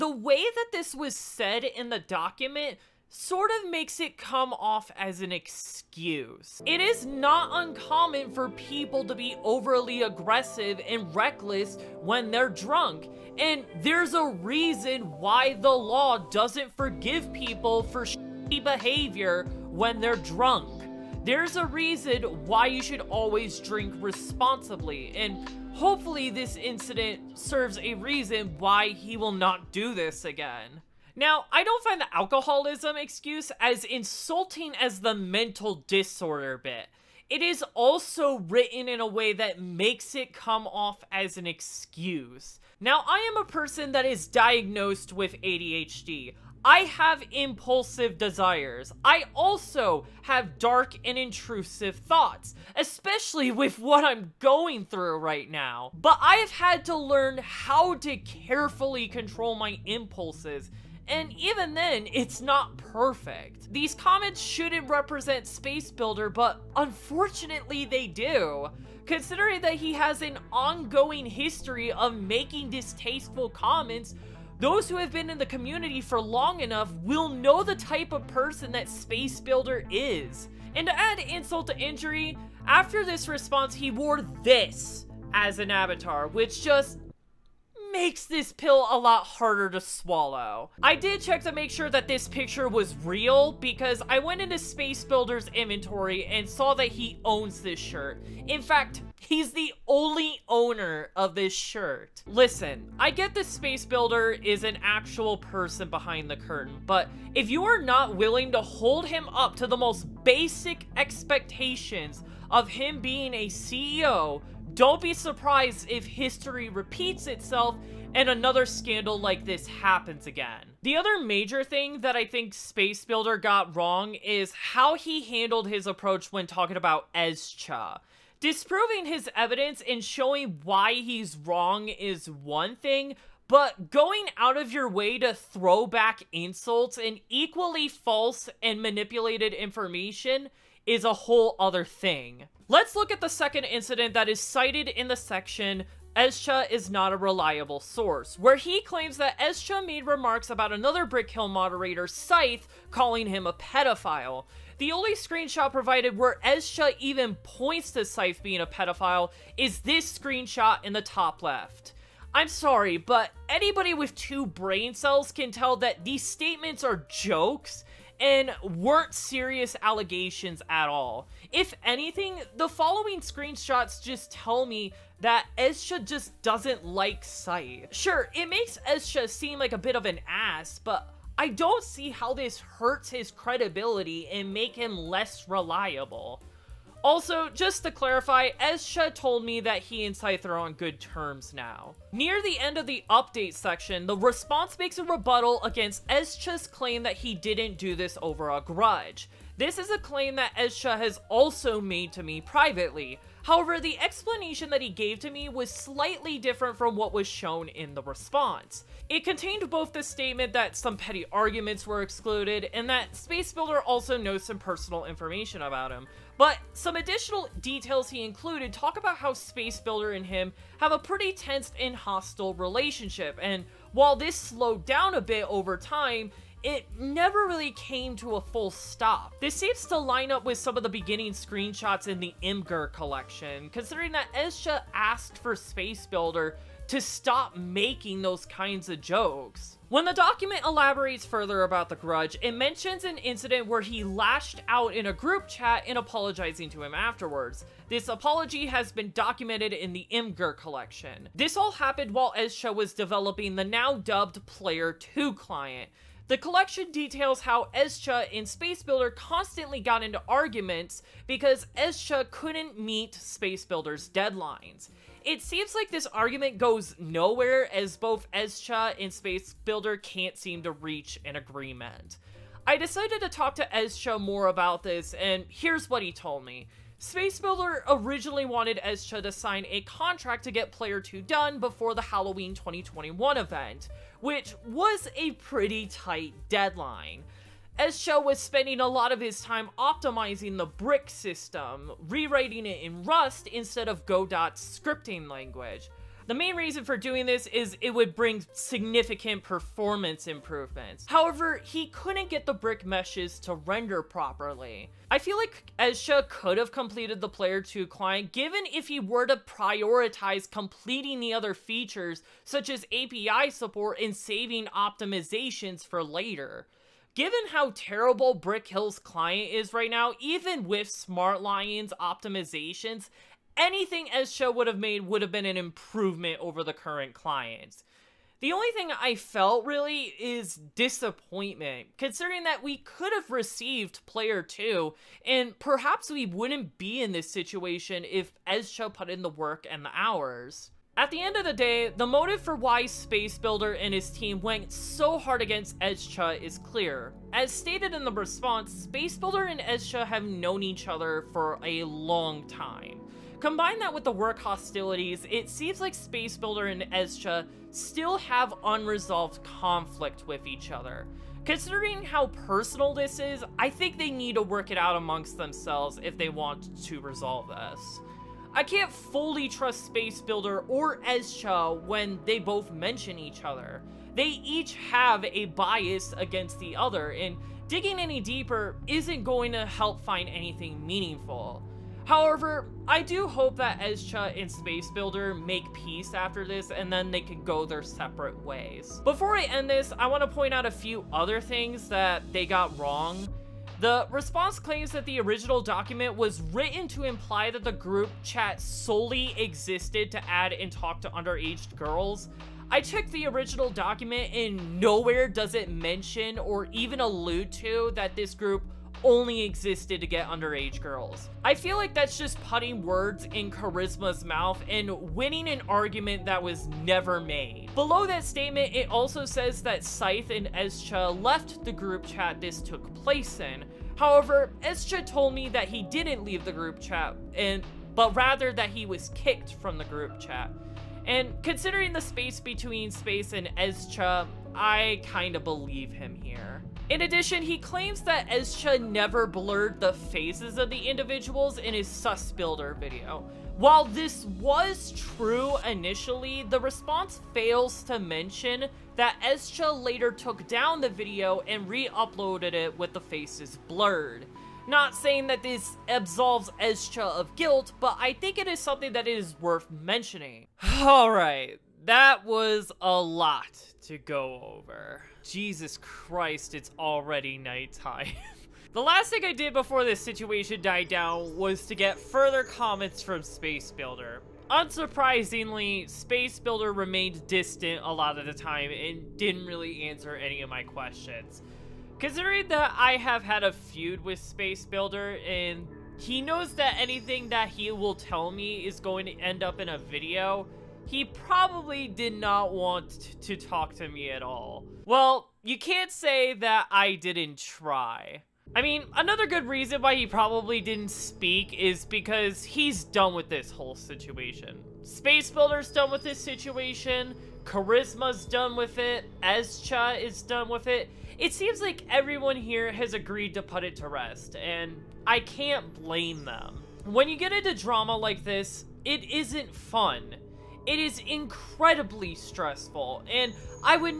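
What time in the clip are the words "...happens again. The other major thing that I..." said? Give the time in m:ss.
1:59.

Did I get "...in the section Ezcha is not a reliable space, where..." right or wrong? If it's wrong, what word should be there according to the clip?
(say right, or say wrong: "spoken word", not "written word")
wrong: "source", not "space".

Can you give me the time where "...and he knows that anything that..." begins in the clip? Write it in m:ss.
8:05.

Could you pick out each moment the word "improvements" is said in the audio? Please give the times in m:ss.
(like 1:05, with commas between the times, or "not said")
5:00, 5:25.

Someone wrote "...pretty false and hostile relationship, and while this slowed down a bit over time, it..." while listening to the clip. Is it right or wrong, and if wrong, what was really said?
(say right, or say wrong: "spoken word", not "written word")
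wrong: "tense", not "false".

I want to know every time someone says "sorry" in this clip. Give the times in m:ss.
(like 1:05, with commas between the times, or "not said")
2:42.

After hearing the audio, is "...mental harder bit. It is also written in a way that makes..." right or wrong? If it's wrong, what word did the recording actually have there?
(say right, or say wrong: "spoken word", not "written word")
wrong: "disorder", not "harder".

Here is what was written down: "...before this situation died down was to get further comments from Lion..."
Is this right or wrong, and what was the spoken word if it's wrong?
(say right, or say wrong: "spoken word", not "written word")
wrong: "Space", not "Lion".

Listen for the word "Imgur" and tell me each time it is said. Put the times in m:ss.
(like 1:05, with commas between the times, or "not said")
3:52, 4:10.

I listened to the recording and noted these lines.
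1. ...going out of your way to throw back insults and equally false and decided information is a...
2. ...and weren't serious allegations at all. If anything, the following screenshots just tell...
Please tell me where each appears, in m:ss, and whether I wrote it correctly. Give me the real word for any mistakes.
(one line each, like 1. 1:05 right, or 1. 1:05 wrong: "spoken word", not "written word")
1. 2:13 wrong: "manipulated", not "decided"
2. 2:48 right.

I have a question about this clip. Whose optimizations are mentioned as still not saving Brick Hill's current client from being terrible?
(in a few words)
Smart Lion.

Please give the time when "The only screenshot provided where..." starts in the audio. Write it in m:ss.
2:34.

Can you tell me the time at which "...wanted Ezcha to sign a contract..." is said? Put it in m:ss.
4:38.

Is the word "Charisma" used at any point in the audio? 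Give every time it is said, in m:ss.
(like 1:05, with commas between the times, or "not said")
6:53, 8:27.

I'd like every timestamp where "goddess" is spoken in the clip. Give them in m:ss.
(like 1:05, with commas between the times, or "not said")
not said.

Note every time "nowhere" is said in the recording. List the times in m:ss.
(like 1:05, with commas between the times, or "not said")
4:26, 6:44.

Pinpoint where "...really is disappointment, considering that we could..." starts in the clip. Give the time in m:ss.
5:29.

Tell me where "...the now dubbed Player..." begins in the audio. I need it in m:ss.
4:13.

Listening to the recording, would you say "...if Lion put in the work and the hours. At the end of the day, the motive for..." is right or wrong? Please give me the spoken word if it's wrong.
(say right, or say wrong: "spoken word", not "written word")
wrong: "Ezcha", not "Lion".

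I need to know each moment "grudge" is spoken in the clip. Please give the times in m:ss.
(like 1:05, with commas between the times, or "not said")
3:18, 4:01.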